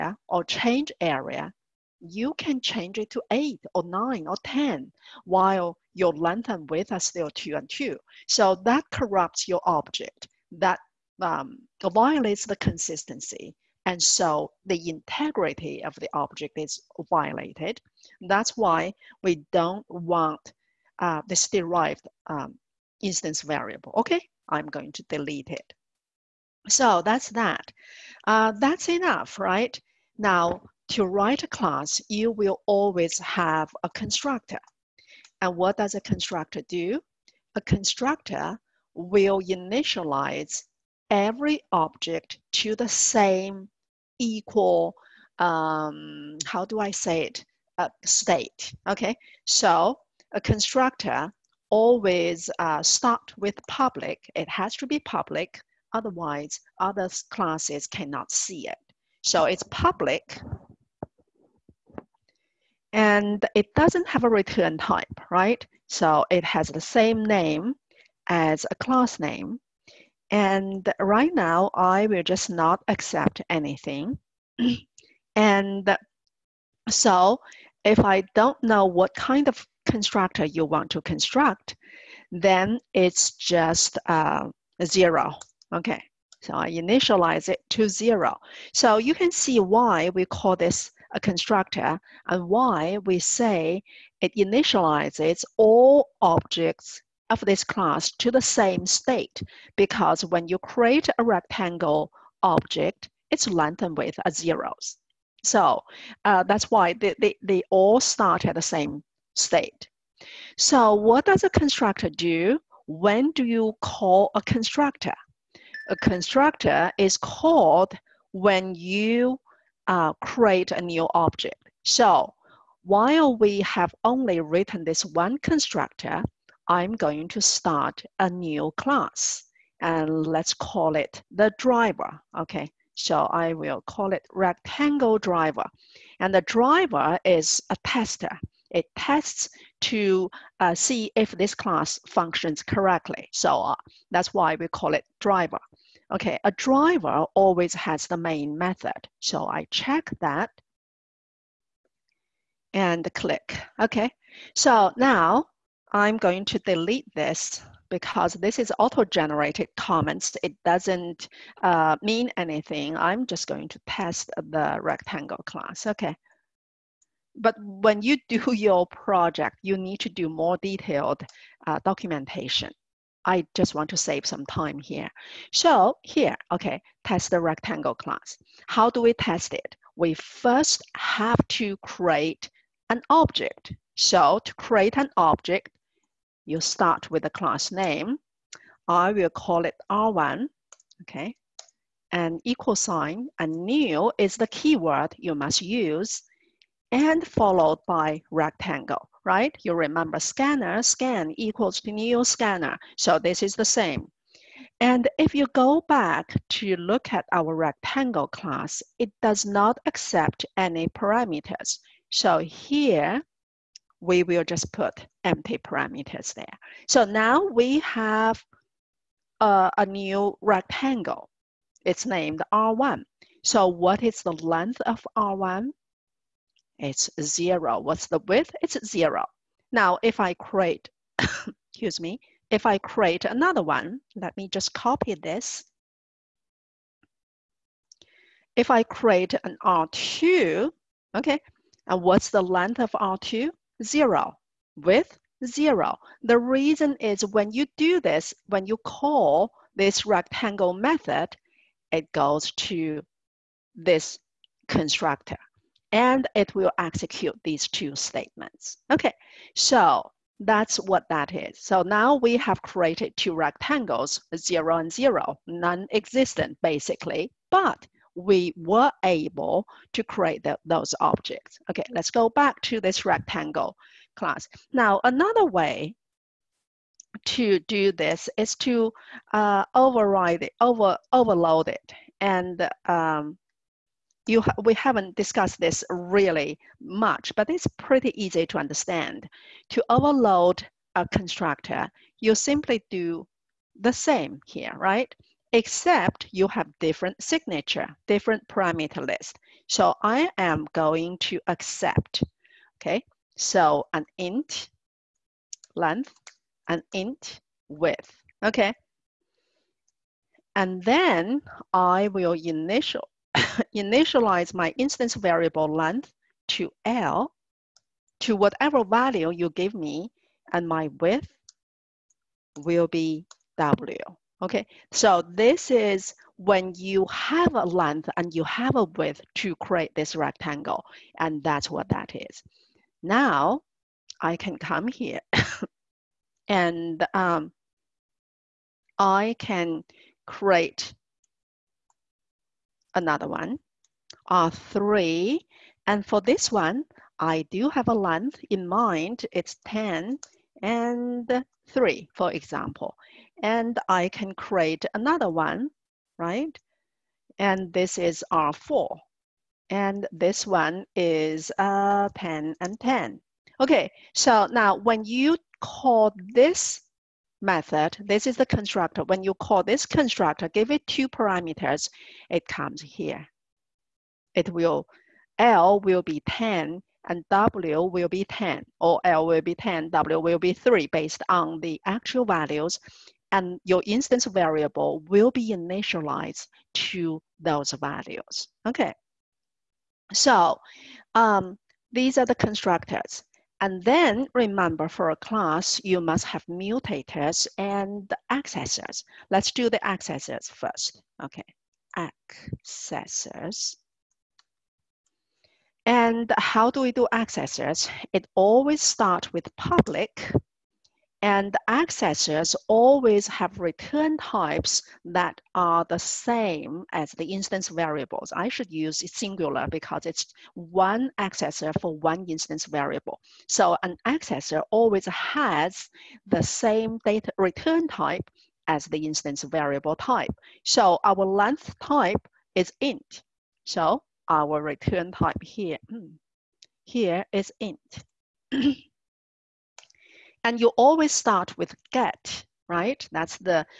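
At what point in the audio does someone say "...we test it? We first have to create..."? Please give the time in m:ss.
2:59.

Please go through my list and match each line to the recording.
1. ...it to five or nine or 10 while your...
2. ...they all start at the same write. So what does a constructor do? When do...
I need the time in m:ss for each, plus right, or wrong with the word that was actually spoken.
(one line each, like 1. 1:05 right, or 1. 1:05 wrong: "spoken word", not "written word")
1. 0:02 wrong: "eight", not "five"
2. 1:47 wrong: "state", not "write".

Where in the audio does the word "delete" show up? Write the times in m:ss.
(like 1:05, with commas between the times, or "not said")
0:25, 2:36.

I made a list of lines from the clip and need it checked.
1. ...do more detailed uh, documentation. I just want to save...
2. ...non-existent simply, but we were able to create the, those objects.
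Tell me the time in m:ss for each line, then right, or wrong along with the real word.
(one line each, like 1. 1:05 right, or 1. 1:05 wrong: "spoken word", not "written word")
1. 2:50 right
2. 4:25 wrong: "basically", not "simply".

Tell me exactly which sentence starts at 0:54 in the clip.
It has to be public Otherwise, other classes cannot see it.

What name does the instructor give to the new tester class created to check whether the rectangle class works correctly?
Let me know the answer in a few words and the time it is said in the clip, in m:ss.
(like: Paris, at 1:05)
Rectangle driver, at 2:14.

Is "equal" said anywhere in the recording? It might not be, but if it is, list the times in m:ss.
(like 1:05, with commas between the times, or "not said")
0:44, 3:12, 3:21.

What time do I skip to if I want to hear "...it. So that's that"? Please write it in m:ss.
0:25.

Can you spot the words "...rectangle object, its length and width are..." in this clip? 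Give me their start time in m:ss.
1:41.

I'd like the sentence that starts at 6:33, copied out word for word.
And then remember for a class, you must have mutators and accessors.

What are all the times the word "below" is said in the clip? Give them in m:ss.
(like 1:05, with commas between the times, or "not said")
not said.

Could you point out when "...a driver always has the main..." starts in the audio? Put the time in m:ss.
2:26.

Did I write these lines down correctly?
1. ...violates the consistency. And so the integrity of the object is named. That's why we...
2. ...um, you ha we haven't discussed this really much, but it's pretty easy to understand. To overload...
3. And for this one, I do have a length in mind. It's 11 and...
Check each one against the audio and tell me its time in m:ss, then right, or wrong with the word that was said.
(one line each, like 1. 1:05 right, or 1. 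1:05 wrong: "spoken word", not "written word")
1. 0:11 wrong: "violated", not "named"
2. 4:42 right
3. 5:45 wrong: "10", not "11".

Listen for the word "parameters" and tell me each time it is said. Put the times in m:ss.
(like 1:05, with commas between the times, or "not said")
3:30, 3:35, 4:58, 6:11.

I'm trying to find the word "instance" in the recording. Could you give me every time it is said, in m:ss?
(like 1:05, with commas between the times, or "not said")
0:23, 5:14, 6:23, 6:57, 7:02, 7:09.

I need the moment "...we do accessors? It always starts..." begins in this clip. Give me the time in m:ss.
6:46.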